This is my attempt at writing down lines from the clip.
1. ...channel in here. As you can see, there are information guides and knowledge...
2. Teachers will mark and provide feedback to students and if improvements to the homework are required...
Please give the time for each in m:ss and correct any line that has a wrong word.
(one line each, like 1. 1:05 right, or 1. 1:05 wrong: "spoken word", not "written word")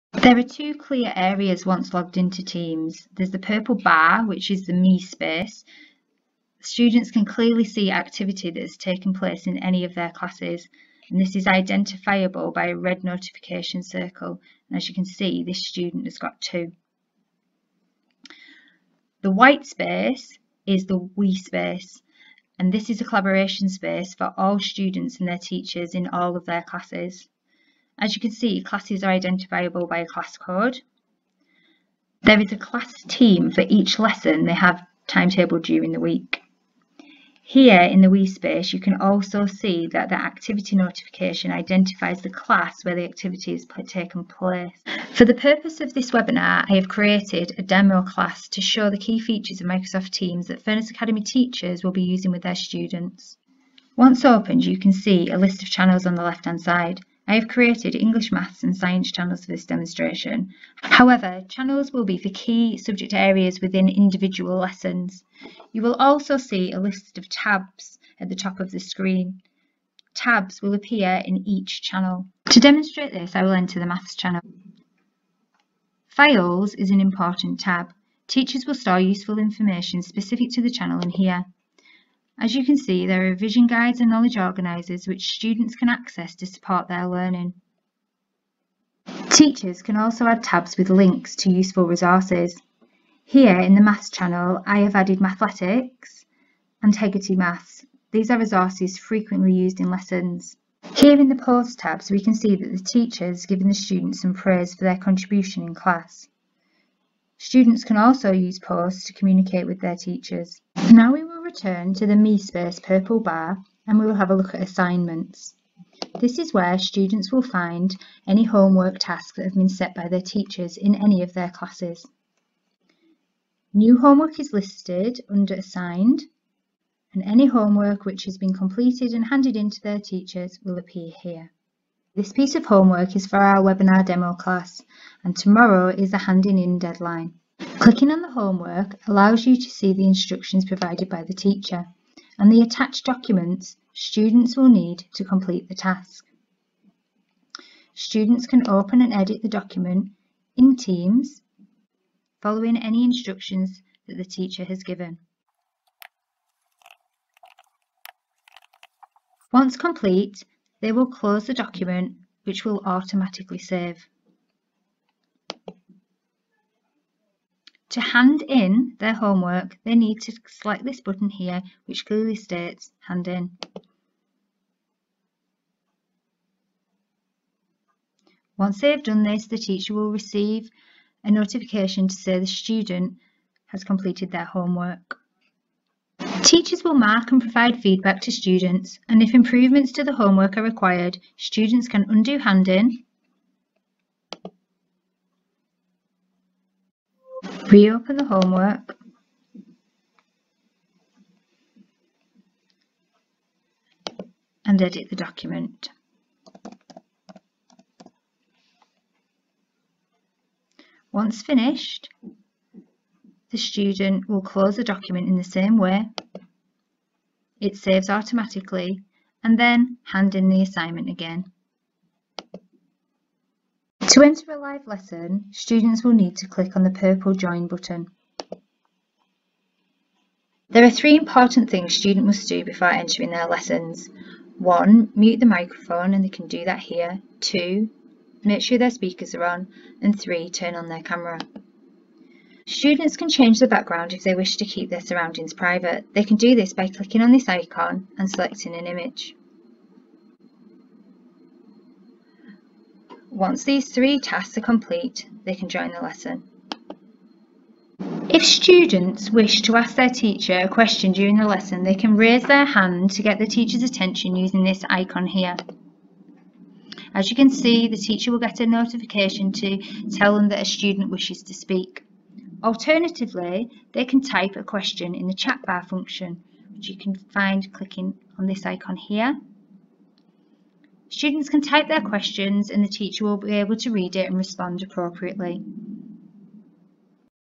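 1. 1:20 wrong: "vision", not "information"
2. 3:06 right.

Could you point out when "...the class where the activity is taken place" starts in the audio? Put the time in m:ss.
0:42.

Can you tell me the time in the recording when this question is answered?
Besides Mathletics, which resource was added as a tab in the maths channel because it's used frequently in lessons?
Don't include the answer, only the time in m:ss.
1:36.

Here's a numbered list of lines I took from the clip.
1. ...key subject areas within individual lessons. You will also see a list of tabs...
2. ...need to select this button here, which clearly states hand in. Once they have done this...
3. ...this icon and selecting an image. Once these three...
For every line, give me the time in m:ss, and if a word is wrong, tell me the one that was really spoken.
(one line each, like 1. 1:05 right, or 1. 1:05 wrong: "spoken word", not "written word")
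1. 1:02 right
2. 2:49 right
3. 4:07 right.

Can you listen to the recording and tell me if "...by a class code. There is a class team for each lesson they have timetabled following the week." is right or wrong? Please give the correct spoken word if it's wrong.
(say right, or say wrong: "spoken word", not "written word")
wrong: "during", not "following".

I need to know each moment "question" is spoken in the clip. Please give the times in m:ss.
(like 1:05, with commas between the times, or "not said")
4:20, 4:34, 4:41.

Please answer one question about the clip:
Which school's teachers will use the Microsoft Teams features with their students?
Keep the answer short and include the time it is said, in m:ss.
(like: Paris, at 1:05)
Furness Academy, at 0:50.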